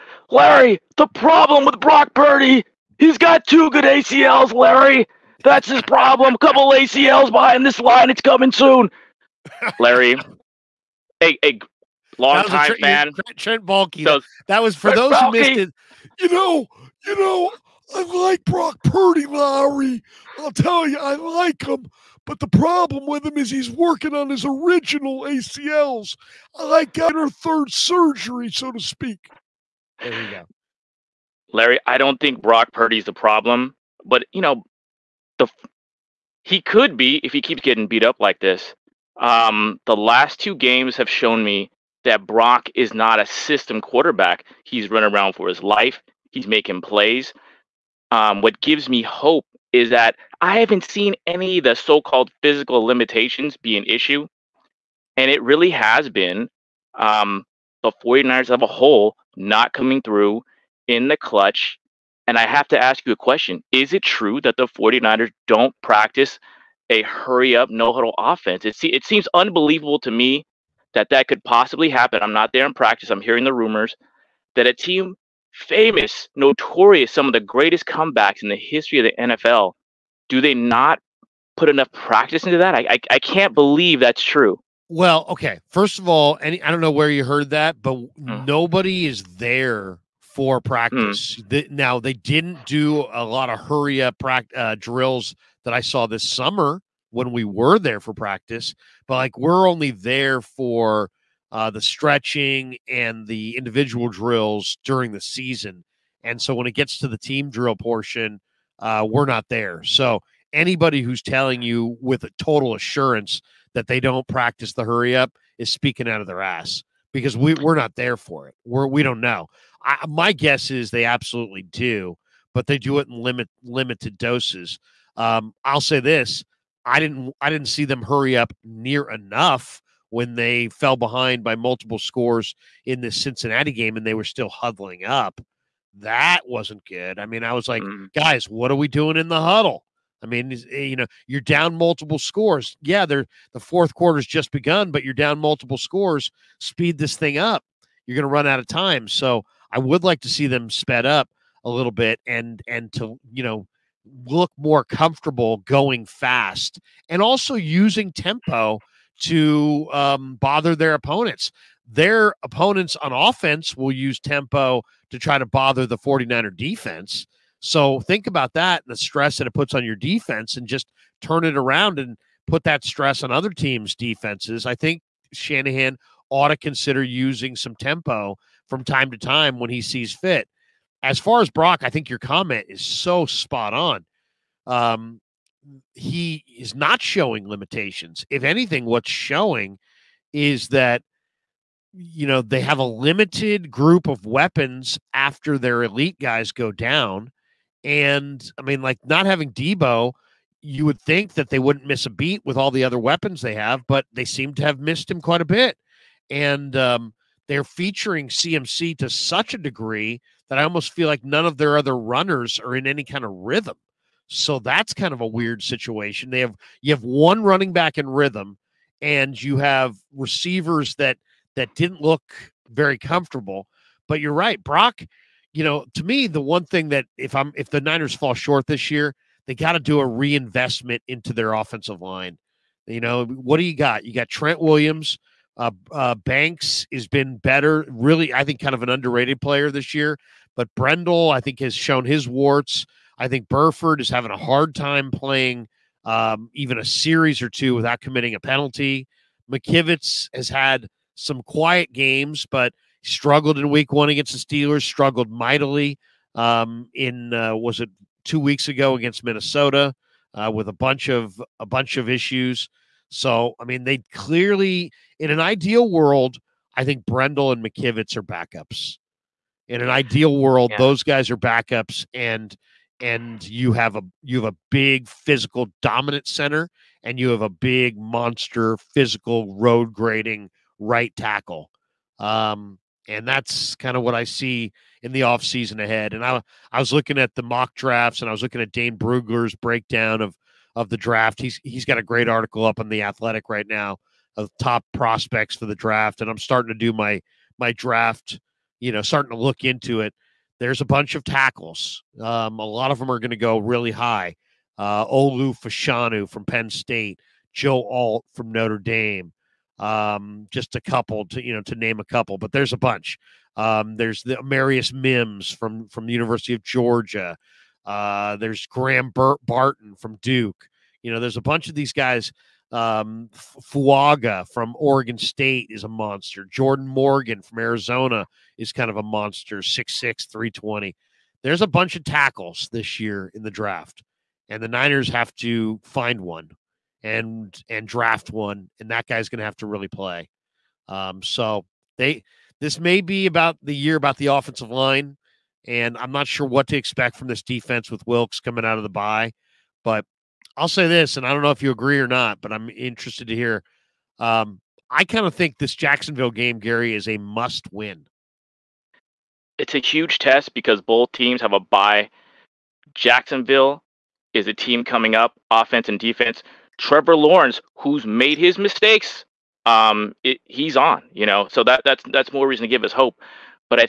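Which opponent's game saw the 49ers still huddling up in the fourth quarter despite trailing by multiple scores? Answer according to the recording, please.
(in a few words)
Cincinnati.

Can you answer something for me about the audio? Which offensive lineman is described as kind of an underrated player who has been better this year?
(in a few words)
Banks.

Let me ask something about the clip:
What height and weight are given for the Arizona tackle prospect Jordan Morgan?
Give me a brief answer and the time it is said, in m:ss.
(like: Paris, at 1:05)
6'6, 320, at 5:29.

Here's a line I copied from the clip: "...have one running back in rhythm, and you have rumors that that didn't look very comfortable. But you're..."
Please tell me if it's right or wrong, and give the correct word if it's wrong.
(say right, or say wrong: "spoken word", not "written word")
wrong: "receivers", not "rumors".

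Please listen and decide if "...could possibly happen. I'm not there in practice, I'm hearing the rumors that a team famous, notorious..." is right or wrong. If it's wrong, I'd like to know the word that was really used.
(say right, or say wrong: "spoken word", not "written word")
right.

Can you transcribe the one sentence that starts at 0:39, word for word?
Um, the last two games have shown me that Brock is not a system quarterback.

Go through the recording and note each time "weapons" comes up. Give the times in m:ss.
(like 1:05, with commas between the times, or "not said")
3:14, 3:22.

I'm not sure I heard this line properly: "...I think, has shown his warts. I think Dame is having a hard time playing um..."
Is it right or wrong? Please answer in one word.
wrong.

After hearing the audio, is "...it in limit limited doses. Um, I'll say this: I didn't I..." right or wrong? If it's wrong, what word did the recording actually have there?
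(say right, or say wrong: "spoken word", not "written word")
right.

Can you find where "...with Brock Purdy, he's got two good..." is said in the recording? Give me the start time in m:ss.
0:01.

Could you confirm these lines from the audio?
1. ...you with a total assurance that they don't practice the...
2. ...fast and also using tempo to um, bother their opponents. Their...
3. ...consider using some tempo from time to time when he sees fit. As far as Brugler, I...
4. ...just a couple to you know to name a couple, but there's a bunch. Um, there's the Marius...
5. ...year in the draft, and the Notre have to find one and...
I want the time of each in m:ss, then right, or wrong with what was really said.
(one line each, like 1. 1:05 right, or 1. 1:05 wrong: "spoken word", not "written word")
1. 1:51 right
2. 2:36 right
3. 2:56 wrong: "Brock", not "Brugler"
4. 5:10 right
5. 5:32 wrong: "Niners", not "Notre".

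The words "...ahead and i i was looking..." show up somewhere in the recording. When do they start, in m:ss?
4:45.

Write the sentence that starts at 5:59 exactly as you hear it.
It's a huge test because both teams have a bye.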